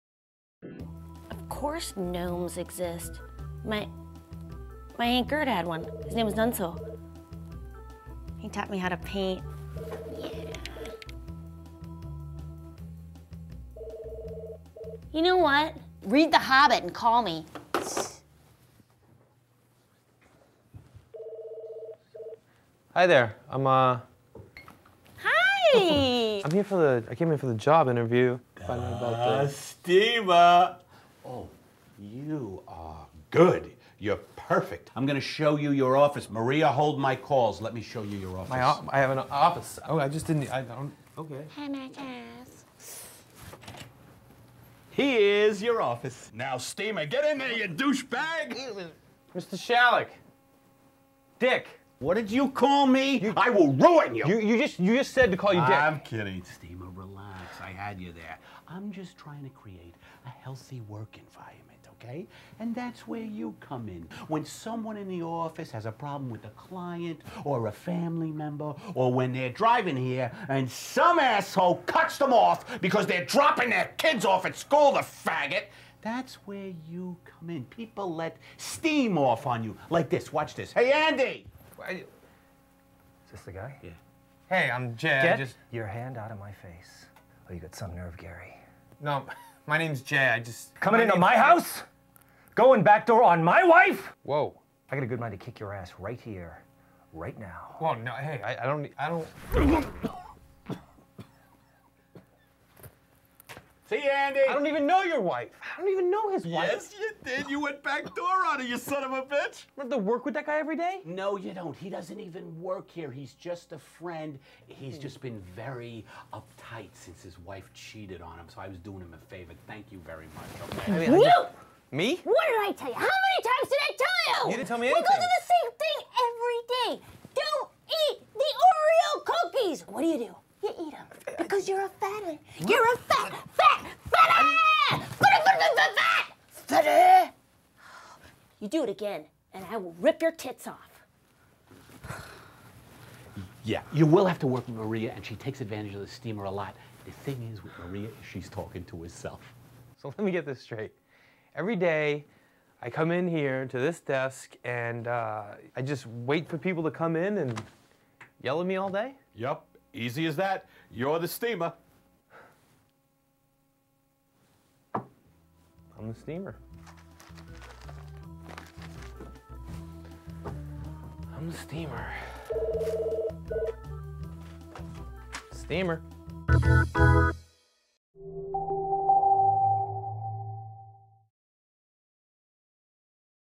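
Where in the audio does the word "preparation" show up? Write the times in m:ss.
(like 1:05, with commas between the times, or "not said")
not said.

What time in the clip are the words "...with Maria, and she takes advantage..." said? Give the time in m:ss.
2:24.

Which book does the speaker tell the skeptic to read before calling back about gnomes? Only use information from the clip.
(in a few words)
The Hobbit.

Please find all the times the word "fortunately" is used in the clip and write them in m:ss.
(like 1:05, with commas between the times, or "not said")
not said.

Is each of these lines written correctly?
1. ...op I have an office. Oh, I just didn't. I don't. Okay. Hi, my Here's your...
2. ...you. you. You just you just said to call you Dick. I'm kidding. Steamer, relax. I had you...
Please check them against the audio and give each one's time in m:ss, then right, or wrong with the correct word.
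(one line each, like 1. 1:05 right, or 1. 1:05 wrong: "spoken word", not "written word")
1. 0:38 right
2. 0:54 right.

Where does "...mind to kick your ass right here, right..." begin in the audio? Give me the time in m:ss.
1:35.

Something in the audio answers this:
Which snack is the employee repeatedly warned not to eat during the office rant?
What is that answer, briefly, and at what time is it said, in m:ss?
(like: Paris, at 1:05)
Oreo cookies, at 2:08.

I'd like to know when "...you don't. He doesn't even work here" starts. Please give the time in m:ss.
1:51.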